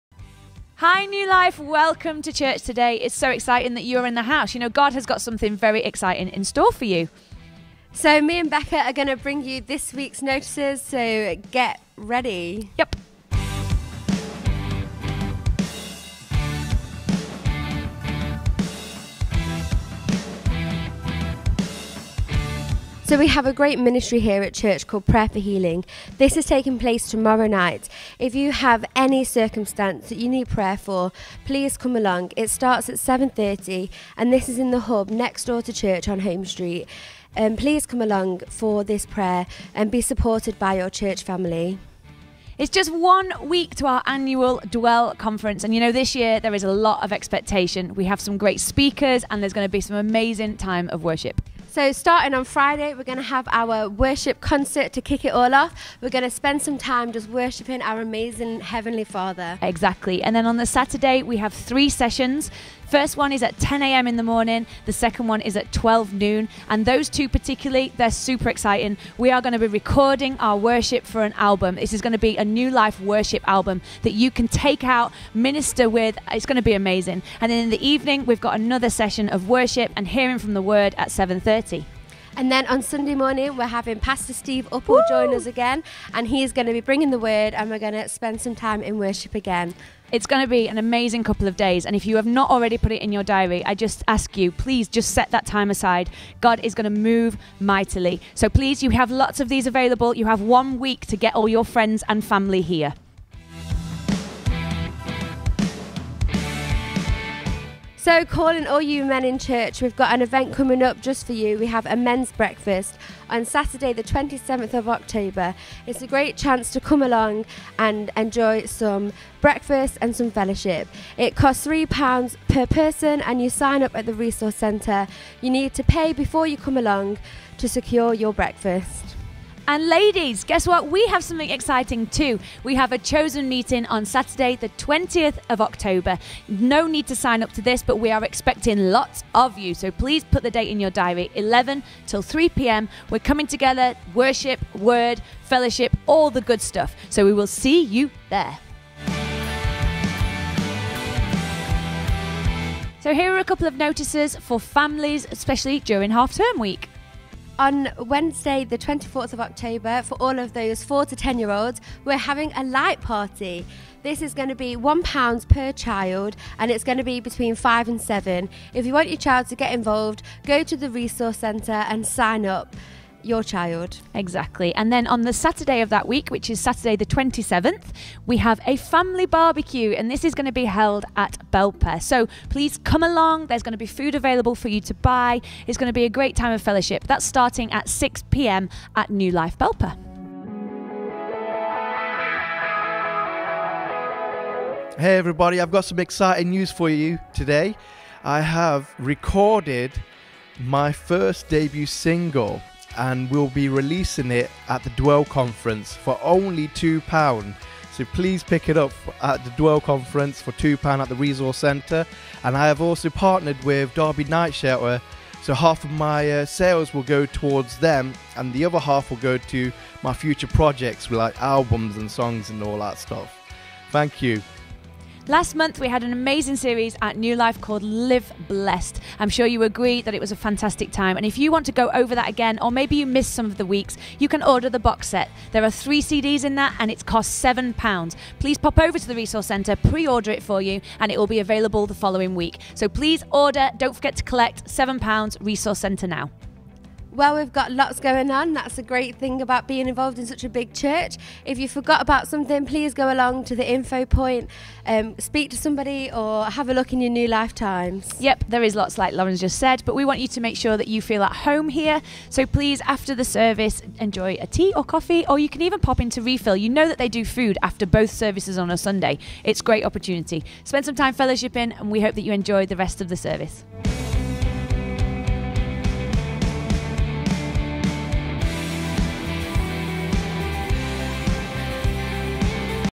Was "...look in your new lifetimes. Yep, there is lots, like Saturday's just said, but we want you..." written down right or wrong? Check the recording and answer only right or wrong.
wrong.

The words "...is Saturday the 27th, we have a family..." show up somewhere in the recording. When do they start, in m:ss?
2:56.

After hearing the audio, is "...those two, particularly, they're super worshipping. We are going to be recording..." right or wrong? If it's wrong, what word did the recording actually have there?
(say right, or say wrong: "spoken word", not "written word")
wrong: "exciting", not "worshipping".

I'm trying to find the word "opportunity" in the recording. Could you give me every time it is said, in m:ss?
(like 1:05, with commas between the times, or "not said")
4:29.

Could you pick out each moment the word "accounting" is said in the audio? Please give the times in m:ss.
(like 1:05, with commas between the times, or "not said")
not said.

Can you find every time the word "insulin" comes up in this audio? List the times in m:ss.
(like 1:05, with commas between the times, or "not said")
not said.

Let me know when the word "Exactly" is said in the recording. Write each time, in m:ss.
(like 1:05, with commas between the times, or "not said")
0:59, 2:54.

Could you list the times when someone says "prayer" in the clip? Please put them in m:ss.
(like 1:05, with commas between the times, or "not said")
0:25, 0:30, 0:39.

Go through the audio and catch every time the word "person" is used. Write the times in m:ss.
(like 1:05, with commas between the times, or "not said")
2:02.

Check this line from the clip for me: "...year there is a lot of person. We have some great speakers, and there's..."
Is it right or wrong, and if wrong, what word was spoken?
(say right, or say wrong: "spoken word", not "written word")
wrong: "expectation", not "person".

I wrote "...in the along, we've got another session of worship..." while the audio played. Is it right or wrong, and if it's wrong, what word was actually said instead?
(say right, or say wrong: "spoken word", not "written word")
wrong: "evening", not "along".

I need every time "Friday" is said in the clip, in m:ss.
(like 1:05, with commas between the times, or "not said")
0:52.